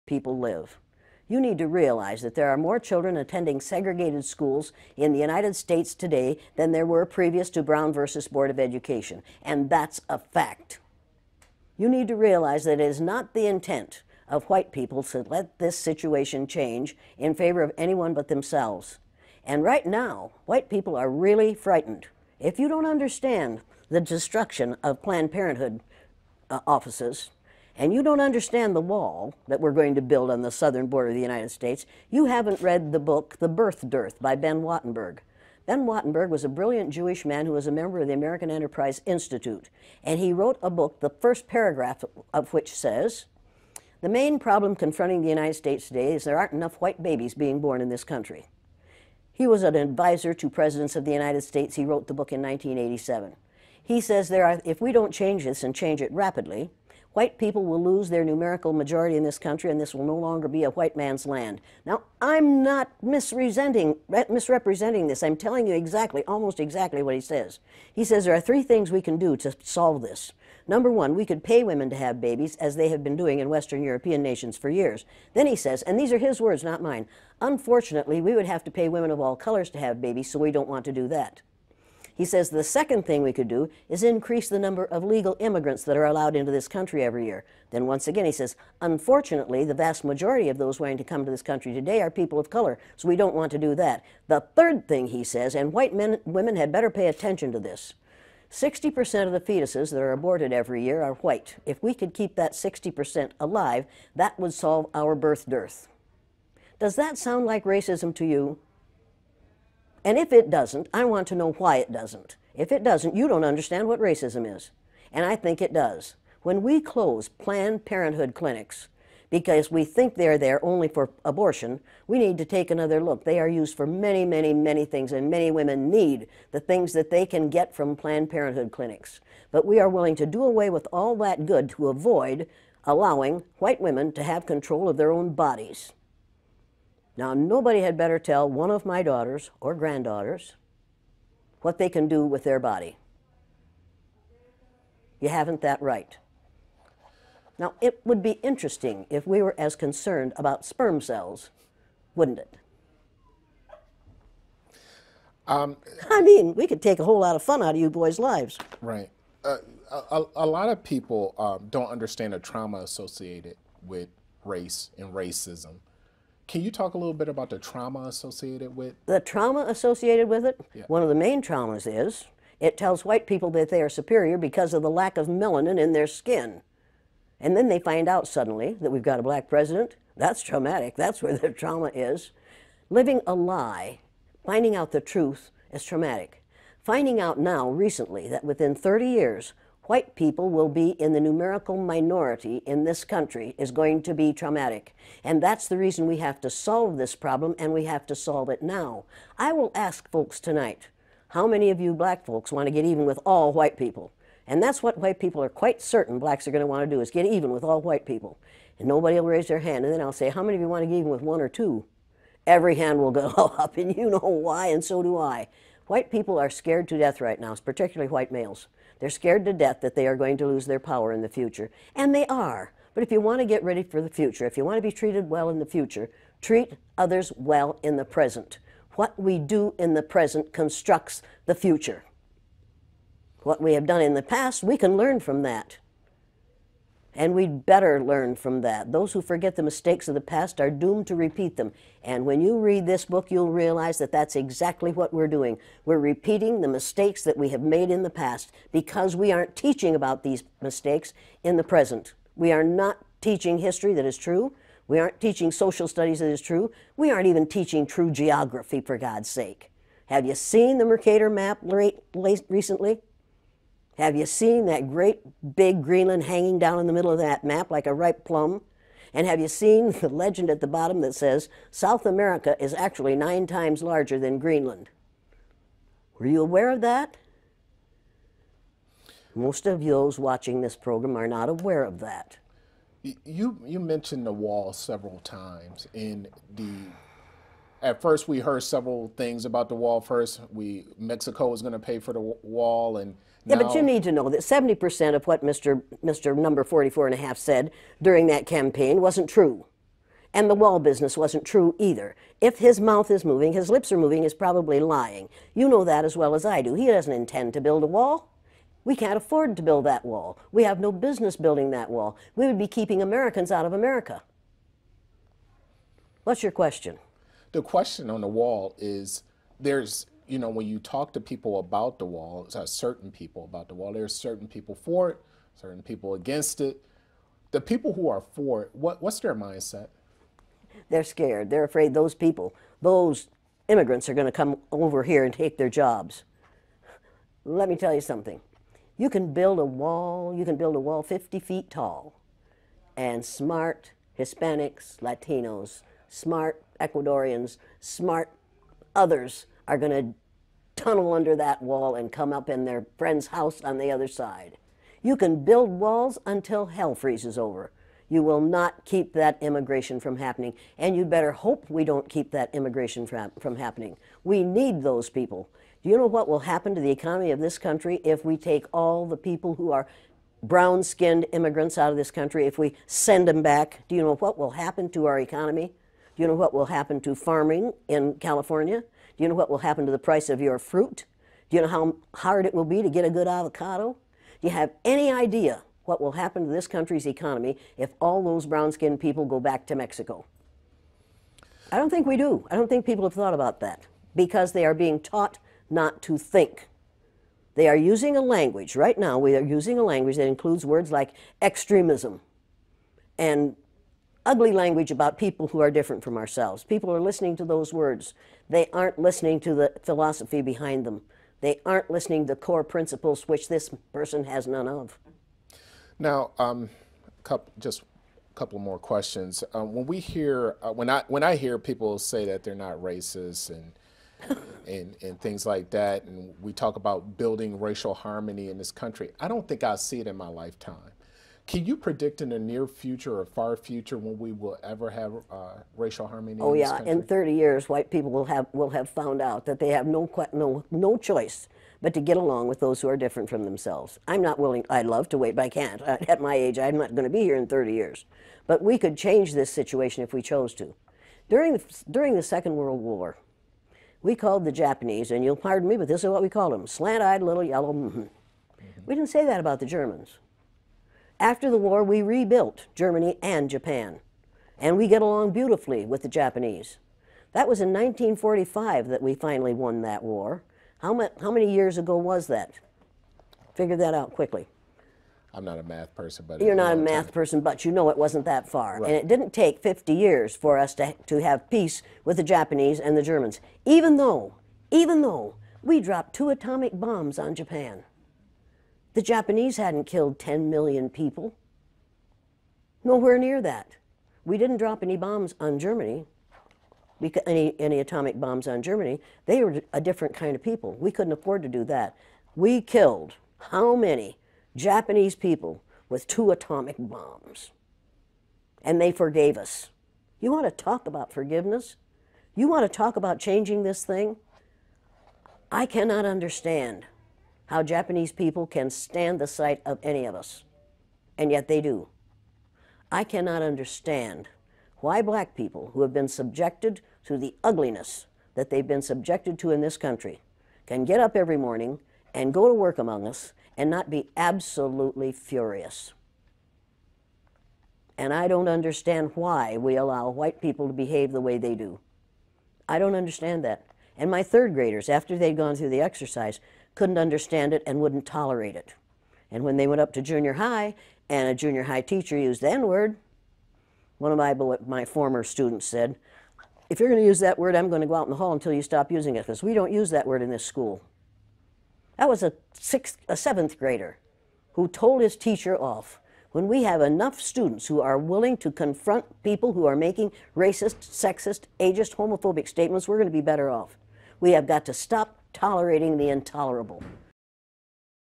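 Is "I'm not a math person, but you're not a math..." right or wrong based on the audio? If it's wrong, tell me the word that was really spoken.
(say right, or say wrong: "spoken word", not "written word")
right.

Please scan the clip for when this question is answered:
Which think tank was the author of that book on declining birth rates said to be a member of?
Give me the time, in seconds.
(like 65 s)
38 s.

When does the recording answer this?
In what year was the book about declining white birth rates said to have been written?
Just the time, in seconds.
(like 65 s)
52 s.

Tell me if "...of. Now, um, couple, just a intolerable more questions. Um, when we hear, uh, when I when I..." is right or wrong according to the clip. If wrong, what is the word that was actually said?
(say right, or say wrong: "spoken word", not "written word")
wrong: "couple", not "intolerable".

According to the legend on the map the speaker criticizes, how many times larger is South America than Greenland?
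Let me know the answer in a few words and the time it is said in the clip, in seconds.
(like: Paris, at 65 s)
9, at 273 s.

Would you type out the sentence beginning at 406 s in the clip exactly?
People are listening to those words.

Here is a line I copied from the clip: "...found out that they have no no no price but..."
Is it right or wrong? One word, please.
wrong.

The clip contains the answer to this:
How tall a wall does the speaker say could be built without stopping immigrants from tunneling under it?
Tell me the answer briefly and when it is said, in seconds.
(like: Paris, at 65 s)
50 feet, at 341 s.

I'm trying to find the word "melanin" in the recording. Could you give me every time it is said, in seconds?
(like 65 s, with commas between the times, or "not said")
175 s.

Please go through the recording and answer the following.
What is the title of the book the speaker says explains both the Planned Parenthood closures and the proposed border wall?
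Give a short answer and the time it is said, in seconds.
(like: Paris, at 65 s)
The Birth Dearth, at 33 s.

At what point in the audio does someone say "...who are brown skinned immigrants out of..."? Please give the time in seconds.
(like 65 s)
369 s.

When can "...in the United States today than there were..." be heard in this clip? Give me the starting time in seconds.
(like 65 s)
4 s.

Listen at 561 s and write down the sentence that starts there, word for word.
That was a, sixth, a seventh grader who told his teacher off.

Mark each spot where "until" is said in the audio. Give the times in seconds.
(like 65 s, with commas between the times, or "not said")
356 s, 558 s.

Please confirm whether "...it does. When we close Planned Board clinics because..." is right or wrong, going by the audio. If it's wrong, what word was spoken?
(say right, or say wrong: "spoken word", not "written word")
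wrong: "Parenthood", not "Board".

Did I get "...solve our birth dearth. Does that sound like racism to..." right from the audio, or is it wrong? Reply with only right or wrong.
right.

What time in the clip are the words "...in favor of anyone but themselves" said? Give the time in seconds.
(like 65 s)
17 s.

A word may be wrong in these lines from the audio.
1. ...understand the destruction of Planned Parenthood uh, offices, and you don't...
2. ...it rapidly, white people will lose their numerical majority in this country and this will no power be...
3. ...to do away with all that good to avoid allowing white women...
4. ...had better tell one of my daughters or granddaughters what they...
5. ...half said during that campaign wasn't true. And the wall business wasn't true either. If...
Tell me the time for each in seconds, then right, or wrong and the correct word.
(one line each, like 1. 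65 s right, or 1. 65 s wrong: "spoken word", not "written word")
1. 22 s right
2. 56 s wrong: "longer", not "power"
3. 130 s right
4. 137 s right
5. 297 s right.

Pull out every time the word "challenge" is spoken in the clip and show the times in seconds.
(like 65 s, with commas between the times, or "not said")
not said.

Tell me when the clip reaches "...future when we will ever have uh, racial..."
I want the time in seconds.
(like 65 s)
433 s.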